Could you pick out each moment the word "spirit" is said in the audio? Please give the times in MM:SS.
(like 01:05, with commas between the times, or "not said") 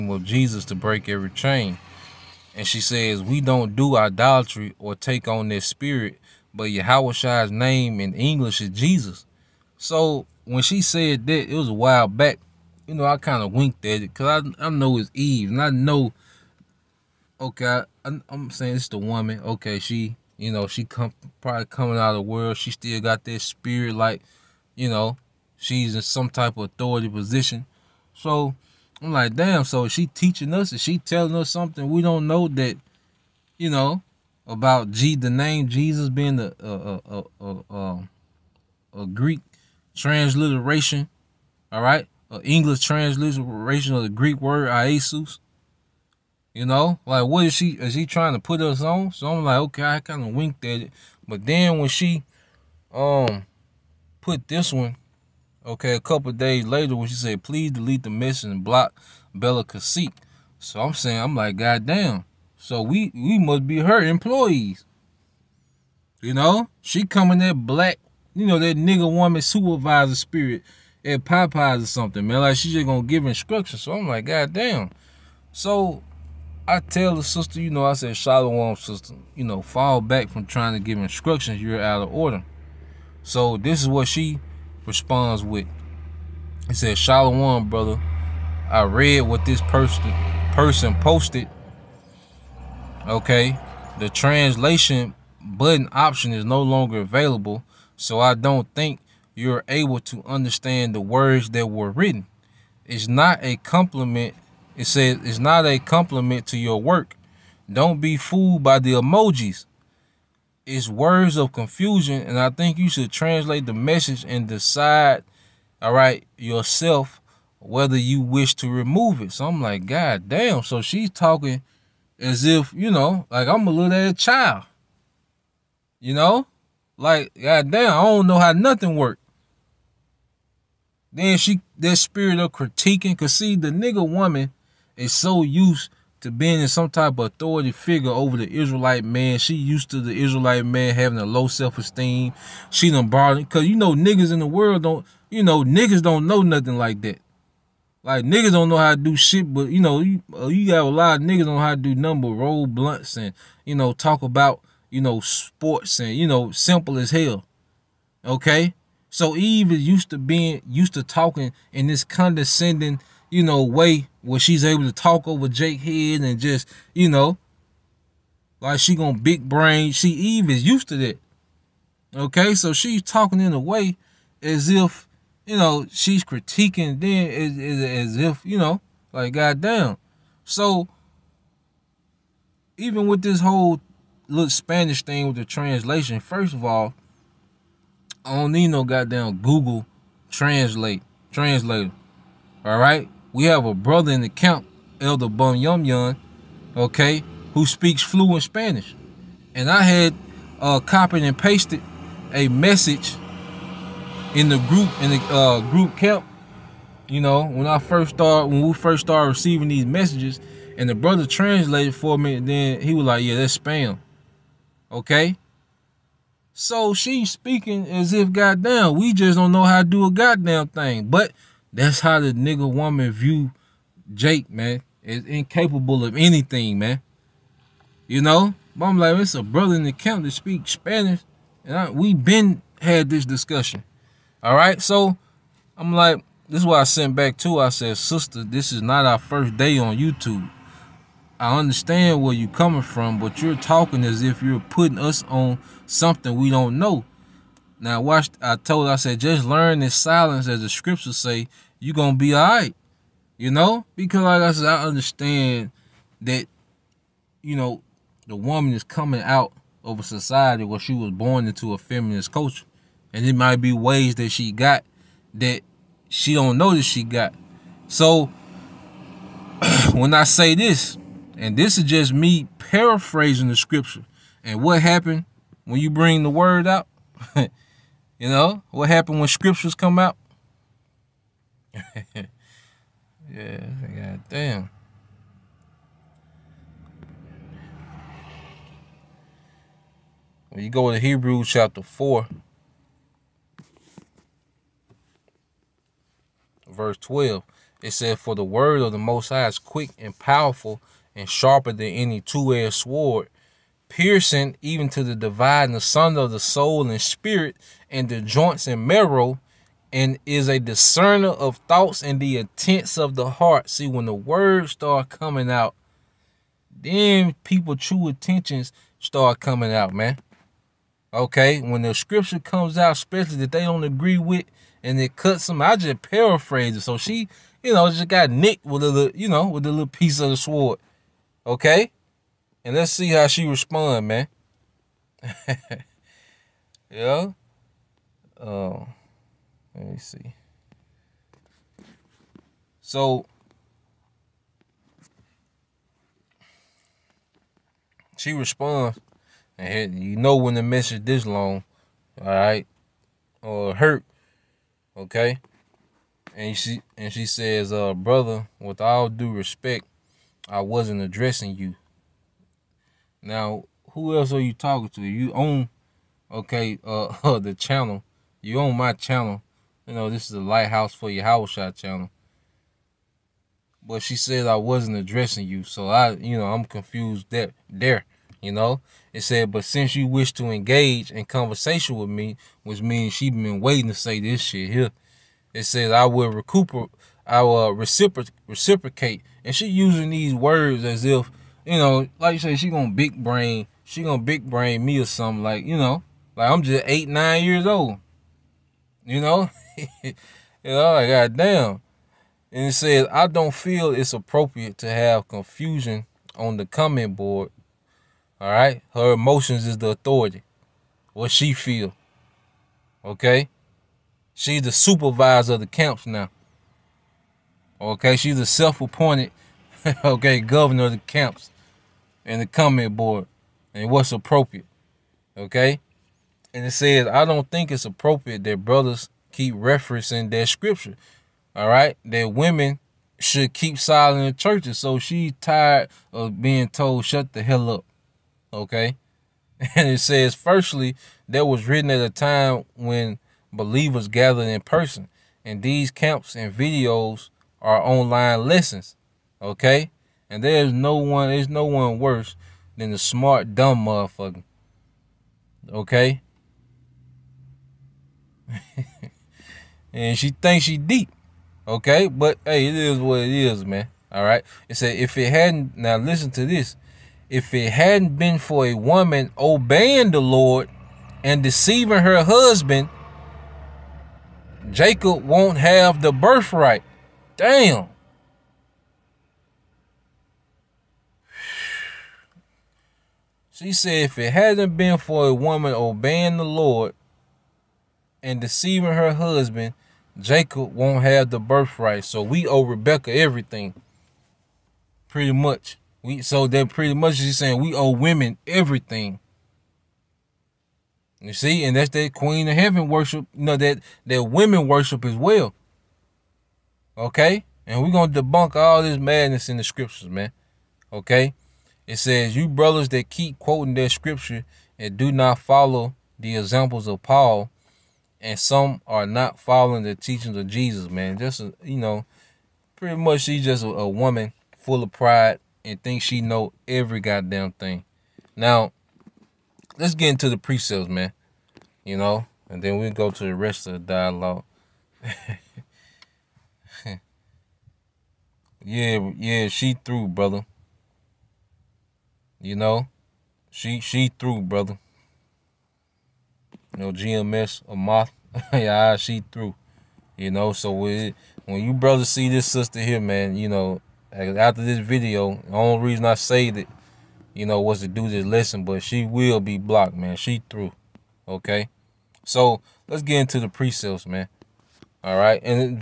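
00:05, 00:23, 01:10, 02:11, 05:07.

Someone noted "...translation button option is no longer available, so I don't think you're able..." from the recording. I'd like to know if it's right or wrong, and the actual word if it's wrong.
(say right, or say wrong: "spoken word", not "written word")
right.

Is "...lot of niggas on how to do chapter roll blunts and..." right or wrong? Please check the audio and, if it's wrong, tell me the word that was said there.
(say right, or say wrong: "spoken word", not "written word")
wrong: "number", not "chapter".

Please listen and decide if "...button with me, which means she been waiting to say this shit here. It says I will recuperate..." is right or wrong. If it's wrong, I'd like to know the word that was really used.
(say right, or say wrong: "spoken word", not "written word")
wrong: "conversation", not "button".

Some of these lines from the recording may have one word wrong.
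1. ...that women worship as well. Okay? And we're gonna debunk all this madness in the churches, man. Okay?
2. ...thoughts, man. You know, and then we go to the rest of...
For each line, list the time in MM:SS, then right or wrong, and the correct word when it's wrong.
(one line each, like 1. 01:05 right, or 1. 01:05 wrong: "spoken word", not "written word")
1. 08:24 wrong: "scriptures", not "churches"
2. 08:50 wrong: "precepts", not "thoughts".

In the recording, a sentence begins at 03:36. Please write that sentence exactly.
So she's speaking as if goddamn, we just don't know how to do a goddamn thing.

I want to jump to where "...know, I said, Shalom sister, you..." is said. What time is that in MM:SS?
01:17.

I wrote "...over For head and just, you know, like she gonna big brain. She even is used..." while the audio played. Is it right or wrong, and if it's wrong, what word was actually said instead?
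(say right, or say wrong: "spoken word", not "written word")
wrong: "Jake", not "For".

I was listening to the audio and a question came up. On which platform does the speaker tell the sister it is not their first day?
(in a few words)
YouTube.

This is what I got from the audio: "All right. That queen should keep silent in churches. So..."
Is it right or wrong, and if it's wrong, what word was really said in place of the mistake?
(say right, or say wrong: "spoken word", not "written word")
wrong: "women", not "queen".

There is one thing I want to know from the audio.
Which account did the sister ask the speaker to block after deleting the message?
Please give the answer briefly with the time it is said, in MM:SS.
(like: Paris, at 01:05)
Bella Cacique, at 00:59.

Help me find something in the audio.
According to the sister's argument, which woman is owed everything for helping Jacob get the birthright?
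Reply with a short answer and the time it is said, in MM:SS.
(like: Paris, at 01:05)
Rebecca, at 08:12.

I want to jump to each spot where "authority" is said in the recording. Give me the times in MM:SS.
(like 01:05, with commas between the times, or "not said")
00:26, 02:17, 06:49.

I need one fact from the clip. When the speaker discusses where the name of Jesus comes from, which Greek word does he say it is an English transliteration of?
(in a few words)
Iesus.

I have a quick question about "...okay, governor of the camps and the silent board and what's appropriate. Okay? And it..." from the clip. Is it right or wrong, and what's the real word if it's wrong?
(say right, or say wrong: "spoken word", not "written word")
wrong: "comment", not "silent".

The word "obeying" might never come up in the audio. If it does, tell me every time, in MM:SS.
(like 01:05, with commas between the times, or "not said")
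07:49, 08:05.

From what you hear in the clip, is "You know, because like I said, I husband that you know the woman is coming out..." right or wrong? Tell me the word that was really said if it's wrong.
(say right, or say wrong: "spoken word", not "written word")
wrong: "understand", not "husband".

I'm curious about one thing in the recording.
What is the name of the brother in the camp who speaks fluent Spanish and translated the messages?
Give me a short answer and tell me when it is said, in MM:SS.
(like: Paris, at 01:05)
Elder Bum Yum Yum, at 03:15.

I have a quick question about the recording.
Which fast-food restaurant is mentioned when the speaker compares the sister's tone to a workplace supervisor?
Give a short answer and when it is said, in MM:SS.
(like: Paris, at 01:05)
Popeyes, at 01:11.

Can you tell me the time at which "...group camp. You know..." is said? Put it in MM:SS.
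03:25.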